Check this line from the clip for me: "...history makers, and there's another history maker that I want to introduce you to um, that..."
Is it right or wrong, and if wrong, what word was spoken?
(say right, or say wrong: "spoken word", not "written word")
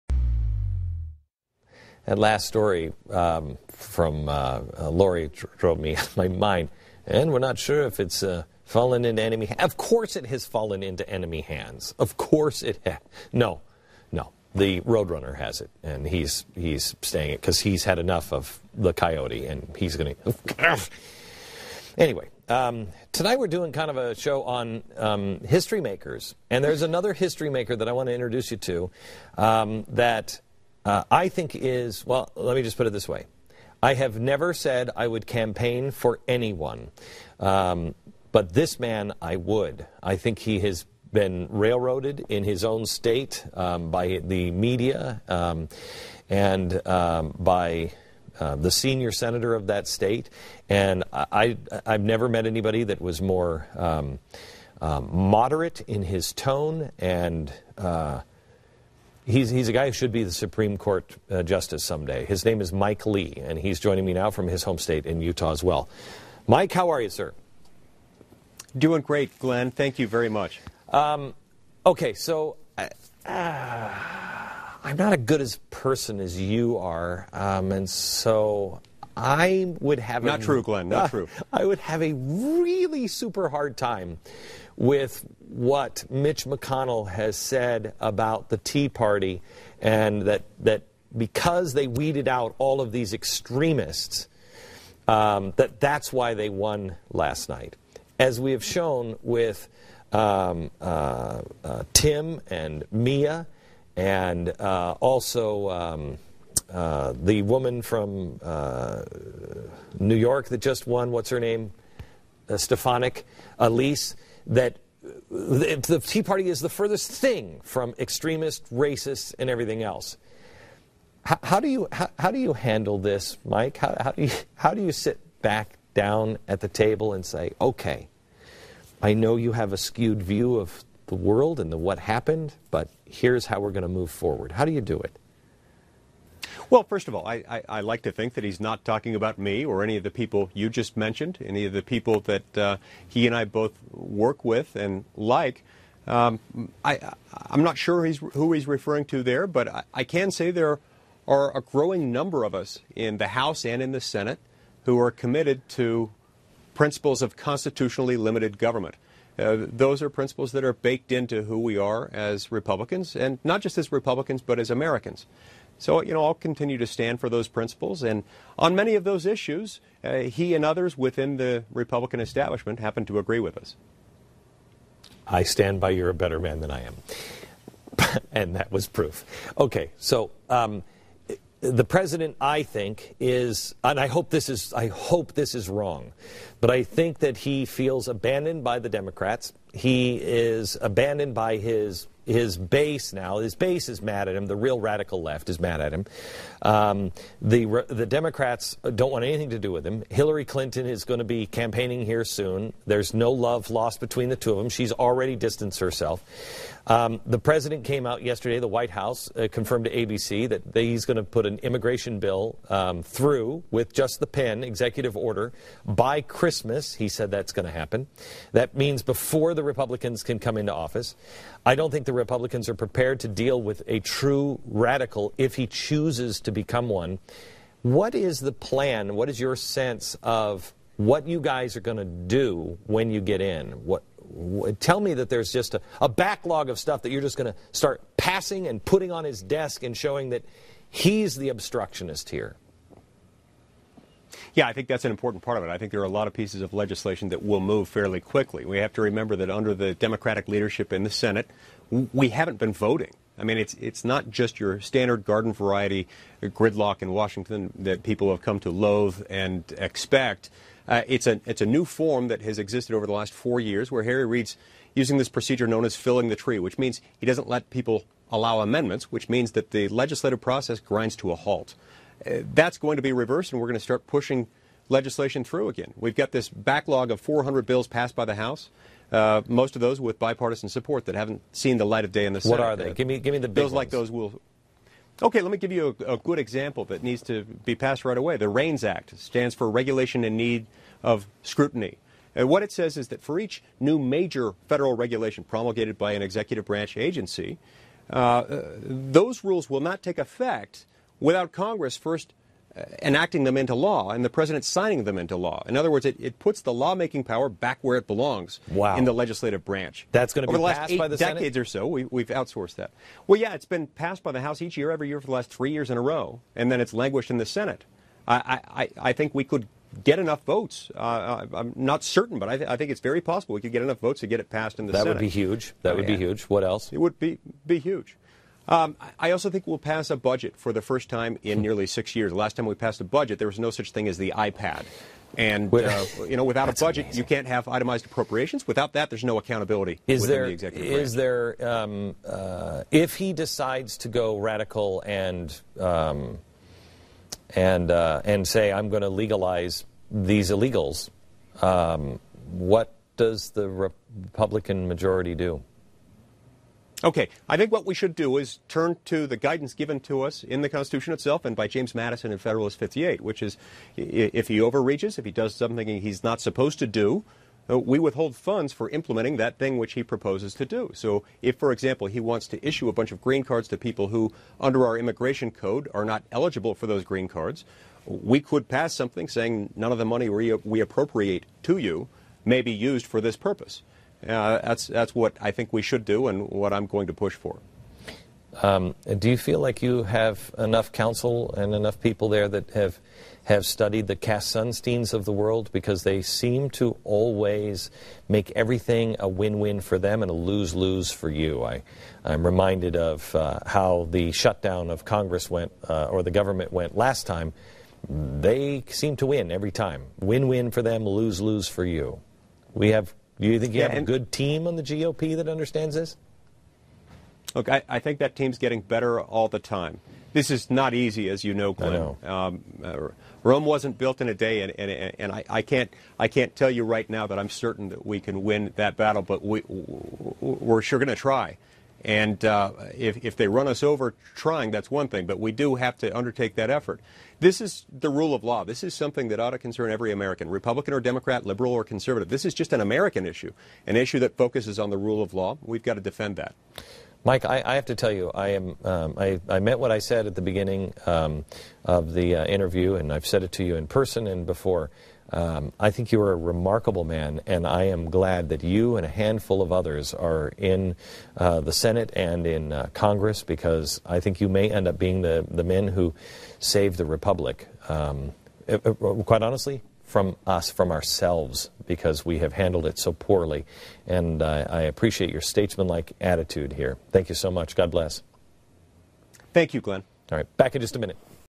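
right.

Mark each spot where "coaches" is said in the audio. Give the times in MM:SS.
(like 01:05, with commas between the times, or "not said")
not said.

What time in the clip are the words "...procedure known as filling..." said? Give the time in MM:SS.
04:25.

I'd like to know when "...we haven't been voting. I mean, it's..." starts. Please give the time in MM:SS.
04:11.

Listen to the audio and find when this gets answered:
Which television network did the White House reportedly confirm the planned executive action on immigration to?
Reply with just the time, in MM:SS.
03:29.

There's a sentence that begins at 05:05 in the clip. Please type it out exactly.
In other words, it, it puts the lawmaking power back where it belongs wow.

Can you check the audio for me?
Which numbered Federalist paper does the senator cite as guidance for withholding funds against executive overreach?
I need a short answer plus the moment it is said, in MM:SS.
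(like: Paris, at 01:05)
Federalist 58, at 06:02.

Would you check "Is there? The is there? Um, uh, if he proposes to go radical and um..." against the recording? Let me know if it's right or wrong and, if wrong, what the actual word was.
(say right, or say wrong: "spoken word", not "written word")
wrong: "decides", not "proposes".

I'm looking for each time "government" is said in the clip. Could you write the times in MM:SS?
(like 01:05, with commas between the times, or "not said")
02:38, 06:46.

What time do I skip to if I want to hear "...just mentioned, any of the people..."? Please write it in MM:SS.
02:20.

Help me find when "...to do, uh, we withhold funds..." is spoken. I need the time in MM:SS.
06:06.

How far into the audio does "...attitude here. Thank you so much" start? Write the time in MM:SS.
07:56.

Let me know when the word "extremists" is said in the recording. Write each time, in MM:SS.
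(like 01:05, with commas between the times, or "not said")
01:33, 01:57.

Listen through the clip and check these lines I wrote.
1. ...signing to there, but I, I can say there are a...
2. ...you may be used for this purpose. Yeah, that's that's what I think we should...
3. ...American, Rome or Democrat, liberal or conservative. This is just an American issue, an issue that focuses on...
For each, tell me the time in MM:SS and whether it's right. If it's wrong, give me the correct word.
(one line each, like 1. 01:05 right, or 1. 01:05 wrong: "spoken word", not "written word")
1. 02:28 wrong: "referring", not "signing"
2. 06:21 right
3. 07:20 wrong: "Republican", not "Rome".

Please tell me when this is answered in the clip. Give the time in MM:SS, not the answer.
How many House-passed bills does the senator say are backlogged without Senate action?
04:37.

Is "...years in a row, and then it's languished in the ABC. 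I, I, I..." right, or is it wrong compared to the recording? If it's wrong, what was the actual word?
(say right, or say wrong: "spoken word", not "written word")
wrong: "Senate", not "ABC".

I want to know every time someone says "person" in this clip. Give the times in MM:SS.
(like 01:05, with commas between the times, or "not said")
01:15, 07:33.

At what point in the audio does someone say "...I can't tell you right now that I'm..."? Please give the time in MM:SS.
07:06.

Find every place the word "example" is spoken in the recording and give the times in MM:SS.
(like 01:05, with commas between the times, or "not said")
04:46, 06:11.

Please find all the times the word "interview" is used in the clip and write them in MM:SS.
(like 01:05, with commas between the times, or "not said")
07:32.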